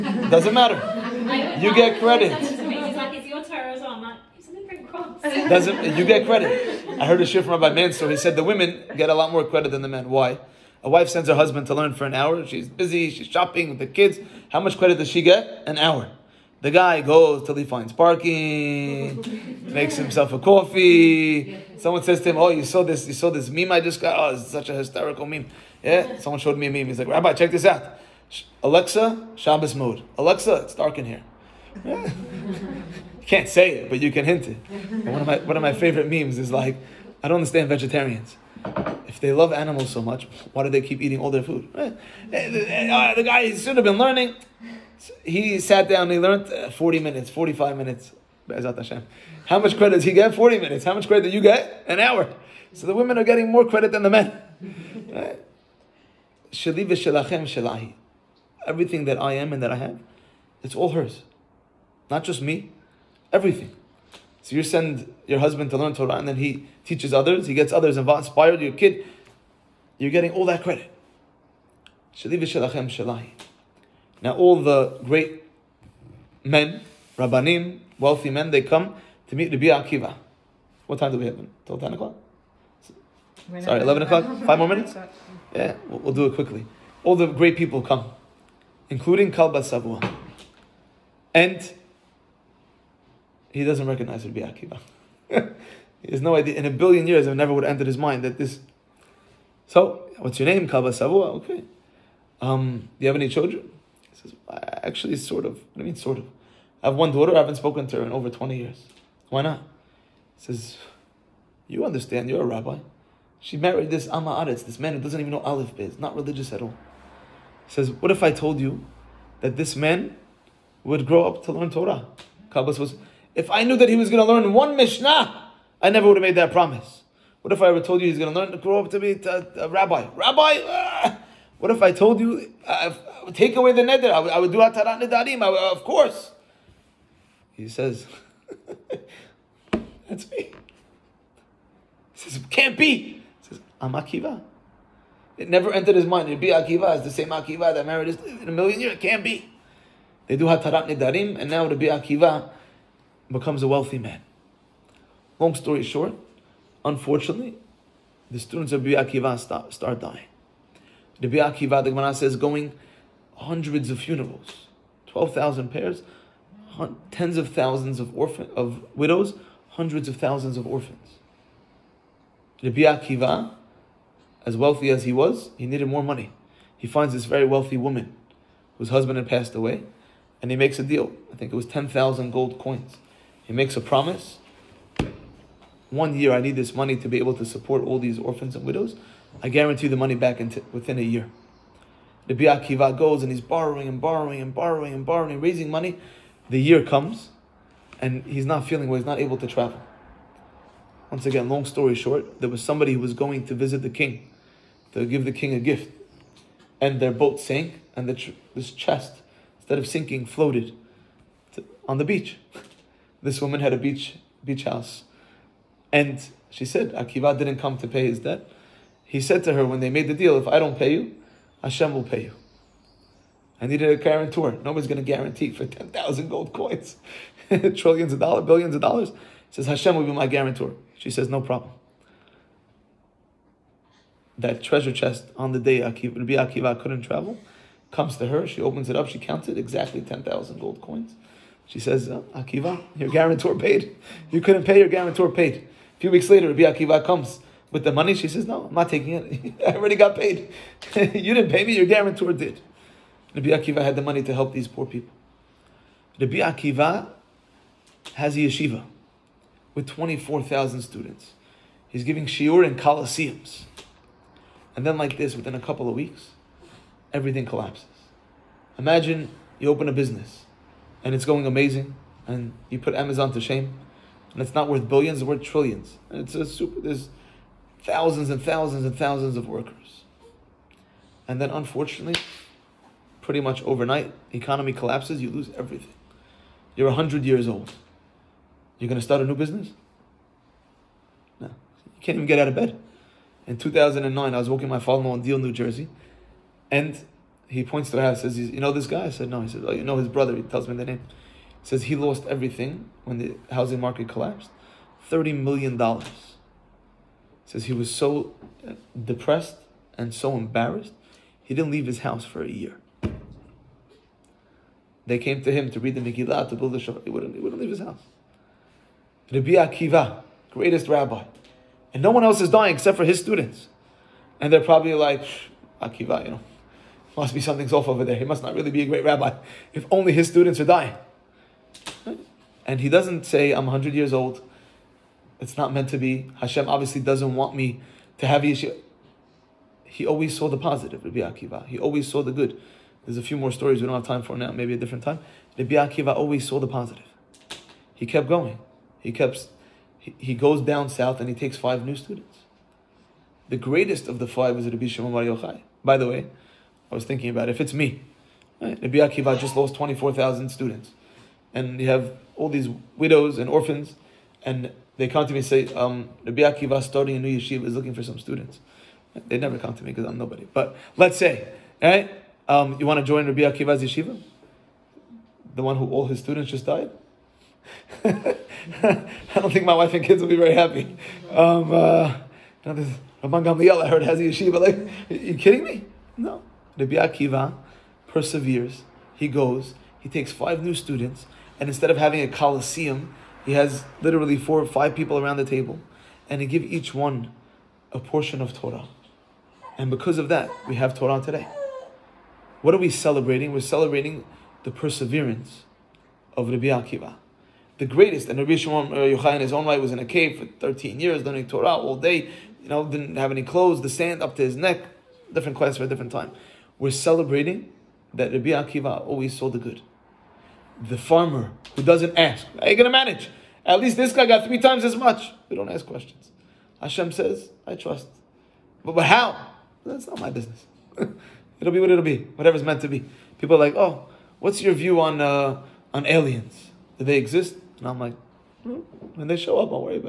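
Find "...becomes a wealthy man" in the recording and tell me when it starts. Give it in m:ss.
2:33.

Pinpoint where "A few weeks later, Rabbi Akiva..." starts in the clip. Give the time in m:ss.
4:05.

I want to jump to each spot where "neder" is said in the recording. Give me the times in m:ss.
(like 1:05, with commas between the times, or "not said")
2:13.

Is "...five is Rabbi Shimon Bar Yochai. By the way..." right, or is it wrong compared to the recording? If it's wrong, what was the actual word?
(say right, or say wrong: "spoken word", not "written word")
right.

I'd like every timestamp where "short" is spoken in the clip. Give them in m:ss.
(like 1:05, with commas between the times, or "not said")
2:35, 3:21.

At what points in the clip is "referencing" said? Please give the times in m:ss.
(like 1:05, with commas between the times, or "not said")
not said.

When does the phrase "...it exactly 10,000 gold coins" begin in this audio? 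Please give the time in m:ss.
3:59.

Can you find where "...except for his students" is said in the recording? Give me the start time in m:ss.
5:22.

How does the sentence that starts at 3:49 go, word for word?
He says, Hashem will be my guarantor.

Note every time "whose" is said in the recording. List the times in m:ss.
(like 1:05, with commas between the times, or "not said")
2:58.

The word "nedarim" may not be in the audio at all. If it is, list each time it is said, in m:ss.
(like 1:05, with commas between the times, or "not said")
2:15, 2:30.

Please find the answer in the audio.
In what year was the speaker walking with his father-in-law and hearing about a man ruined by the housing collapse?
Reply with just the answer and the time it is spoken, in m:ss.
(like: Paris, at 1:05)
2009, at 4:53.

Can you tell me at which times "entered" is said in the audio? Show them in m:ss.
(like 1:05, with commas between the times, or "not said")
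1:37, 2:25.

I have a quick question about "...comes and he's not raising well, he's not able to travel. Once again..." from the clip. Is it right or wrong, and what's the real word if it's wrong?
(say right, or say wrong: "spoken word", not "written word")
wrong: "feeling", not "raising".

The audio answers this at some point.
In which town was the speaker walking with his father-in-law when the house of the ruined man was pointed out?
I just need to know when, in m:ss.
4:55.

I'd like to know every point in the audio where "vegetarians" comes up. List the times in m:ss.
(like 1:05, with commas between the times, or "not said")
0:37.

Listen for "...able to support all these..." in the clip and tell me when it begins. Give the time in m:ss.
3:07.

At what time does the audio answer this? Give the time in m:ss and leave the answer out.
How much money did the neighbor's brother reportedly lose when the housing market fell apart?
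5:05.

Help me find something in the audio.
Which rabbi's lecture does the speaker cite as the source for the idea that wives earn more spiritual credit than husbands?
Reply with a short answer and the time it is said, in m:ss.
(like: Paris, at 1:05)
Rabbi Mansour, at 0:07.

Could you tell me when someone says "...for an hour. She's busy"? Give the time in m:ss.
0:11.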